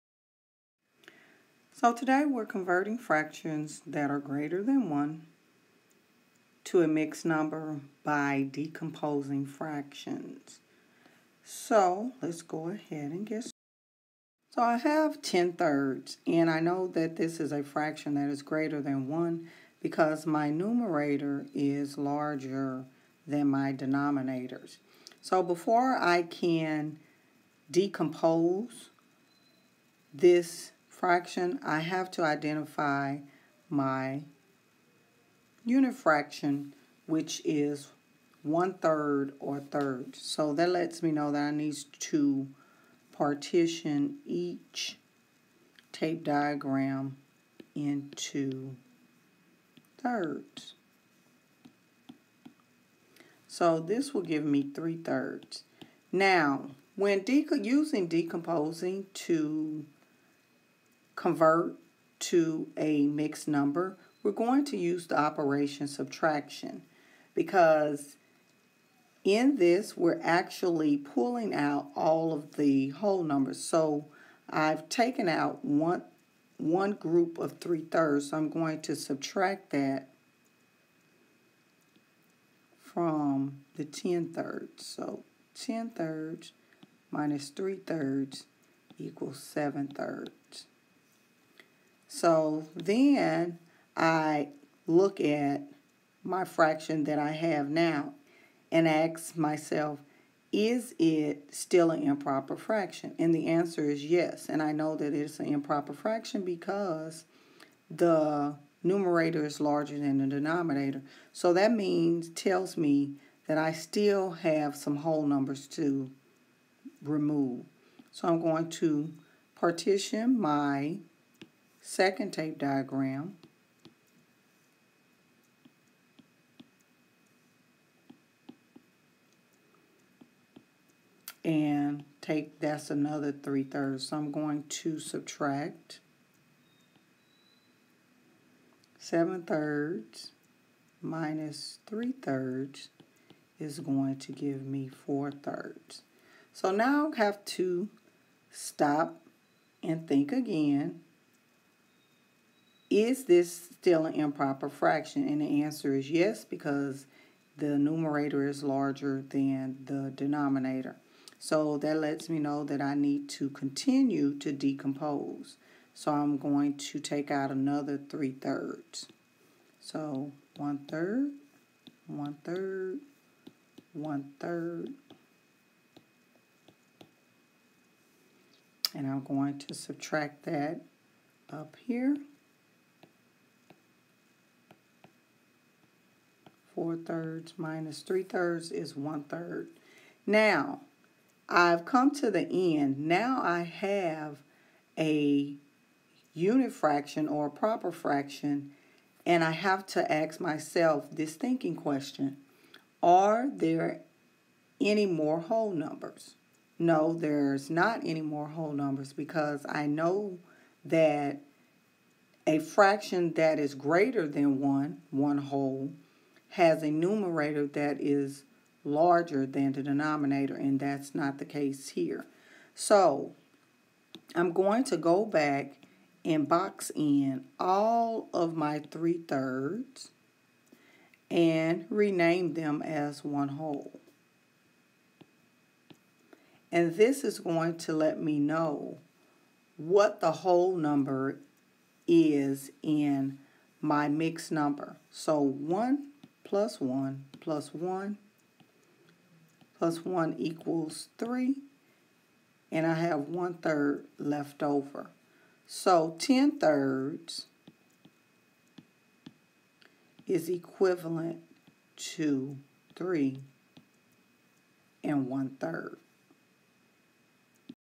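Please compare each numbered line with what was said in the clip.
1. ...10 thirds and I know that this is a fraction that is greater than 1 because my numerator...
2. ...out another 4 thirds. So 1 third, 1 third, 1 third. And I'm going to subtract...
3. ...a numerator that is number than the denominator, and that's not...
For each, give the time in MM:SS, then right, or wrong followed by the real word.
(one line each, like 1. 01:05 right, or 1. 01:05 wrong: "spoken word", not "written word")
1. 00:15 right
2. 02:47 wrong: "3", not "4"
3. 03:36 wrong: "larger", not "number".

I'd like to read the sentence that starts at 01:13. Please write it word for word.
So I've taken out one, one group of 3 thirds, so I'm going to subtract that from the 10 thirds.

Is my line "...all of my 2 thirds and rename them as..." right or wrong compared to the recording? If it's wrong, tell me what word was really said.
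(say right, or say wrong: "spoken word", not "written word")
wrong: "3", not "2".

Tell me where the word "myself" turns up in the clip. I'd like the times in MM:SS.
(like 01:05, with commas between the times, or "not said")
01:39, 03:20.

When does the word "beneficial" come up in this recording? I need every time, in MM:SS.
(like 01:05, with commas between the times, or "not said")
not said.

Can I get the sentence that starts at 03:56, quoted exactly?
And this is going to let me know what the whole number is in my mixed number.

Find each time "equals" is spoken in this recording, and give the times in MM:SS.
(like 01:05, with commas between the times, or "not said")
01:28, 04:10.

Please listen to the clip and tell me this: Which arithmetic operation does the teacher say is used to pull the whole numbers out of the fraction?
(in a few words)
subtraction.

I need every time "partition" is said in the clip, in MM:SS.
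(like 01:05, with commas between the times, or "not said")
00:43, 01:59.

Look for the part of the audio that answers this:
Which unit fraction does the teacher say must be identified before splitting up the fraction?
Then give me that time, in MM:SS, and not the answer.
00:38.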